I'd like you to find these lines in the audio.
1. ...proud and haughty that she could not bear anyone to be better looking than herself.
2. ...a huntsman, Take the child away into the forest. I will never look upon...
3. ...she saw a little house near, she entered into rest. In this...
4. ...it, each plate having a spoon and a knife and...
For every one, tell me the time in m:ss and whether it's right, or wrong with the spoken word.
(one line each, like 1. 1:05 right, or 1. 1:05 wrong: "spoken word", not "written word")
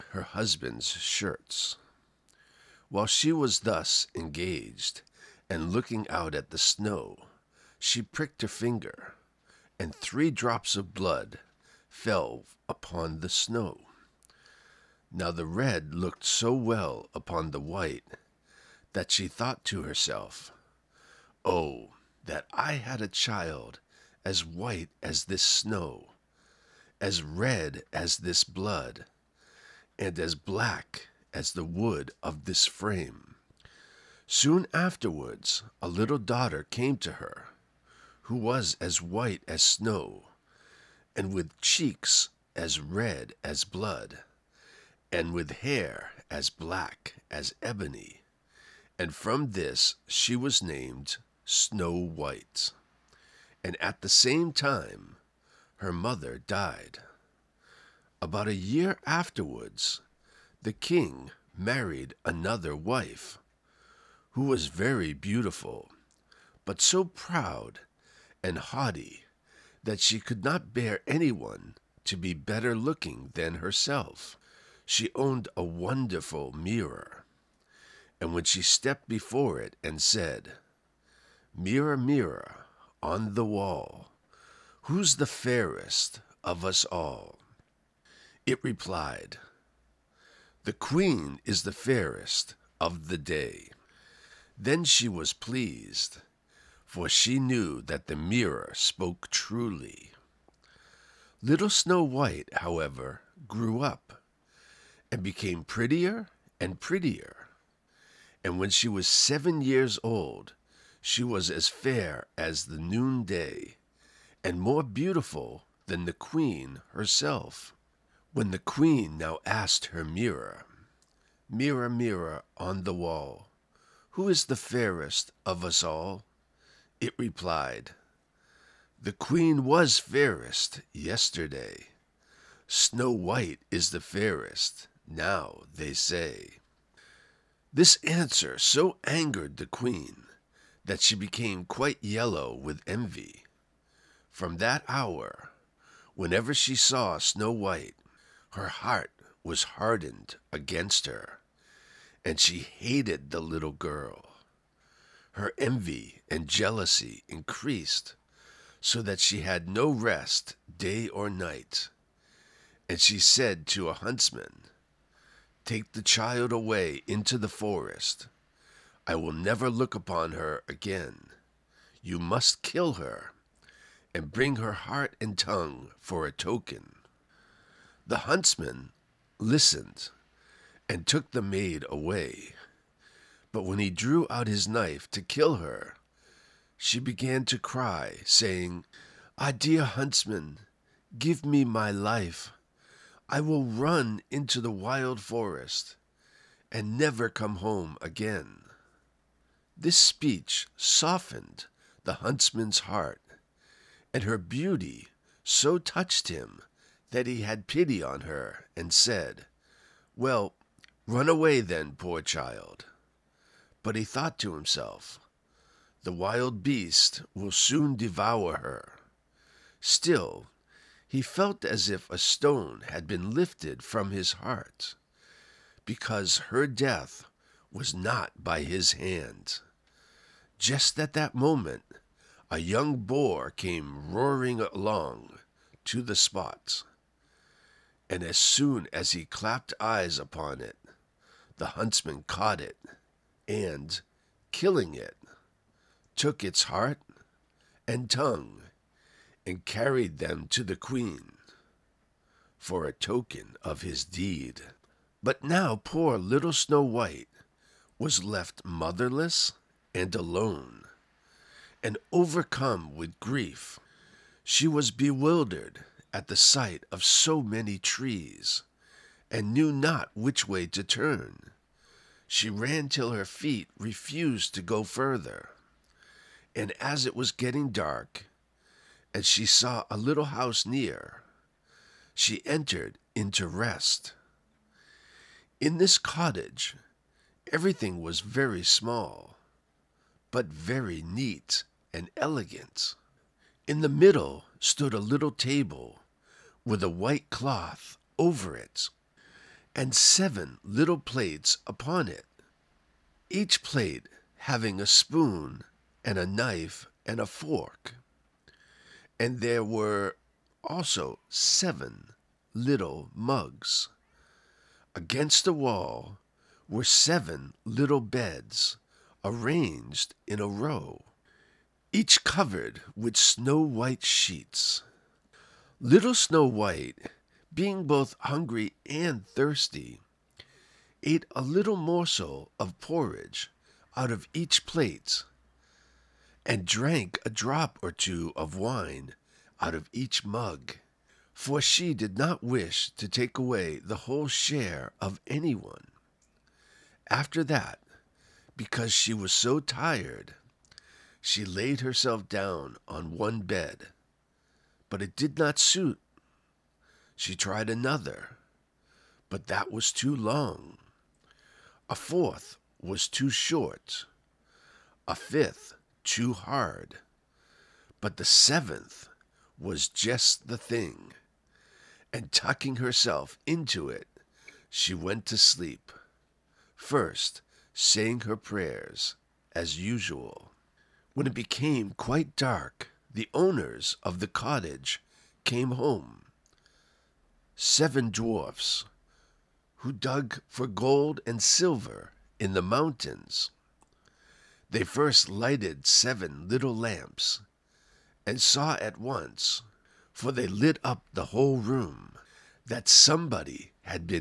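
1. 1:07 right
2. 2:43 right
3. 4:39 right
4. 5:02 right.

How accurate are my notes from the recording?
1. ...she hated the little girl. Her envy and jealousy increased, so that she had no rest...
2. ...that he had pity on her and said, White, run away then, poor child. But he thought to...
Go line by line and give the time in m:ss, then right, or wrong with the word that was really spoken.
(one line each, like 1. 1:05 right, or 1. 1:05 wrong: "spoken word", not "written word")
1. 2:32 right
2. 3:27 wrong: "Well", not "White".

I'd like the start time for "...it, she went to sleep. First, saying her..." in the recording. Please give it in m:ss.
6:13.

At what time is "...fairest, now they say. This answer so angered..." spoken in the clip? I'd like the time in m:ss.
2:14.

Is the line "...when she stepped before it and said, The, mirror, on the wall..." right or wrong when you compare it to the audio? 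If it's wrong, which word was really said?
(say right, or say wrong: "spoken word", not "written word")
wrong: "Mirror", not "The".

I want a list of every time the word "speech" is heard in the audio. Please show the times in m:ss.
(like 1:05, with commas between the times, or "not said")
3:19.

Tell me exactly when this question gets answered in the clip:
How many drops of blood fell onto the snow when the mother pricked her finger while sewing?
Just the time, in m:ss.
0:09.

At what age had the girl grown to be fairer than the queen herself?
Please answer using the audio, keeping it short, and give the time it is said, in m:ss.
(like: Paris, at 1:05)
7, at 1:49.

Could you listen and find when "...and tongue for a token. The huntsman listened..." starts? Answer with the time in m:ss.
2:55.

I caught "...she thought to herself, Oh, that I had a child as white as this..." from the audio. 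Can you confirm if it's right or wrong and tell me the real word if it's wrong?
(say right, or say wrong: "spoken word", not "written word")
right.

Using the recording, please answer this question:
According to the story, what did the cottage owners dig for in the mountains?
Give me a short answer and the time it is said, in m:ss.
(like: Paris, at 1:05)
gold and silver, at 6:30.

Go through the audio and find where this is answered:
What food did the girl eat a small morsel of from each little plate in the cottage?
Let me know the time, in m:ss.
5:32.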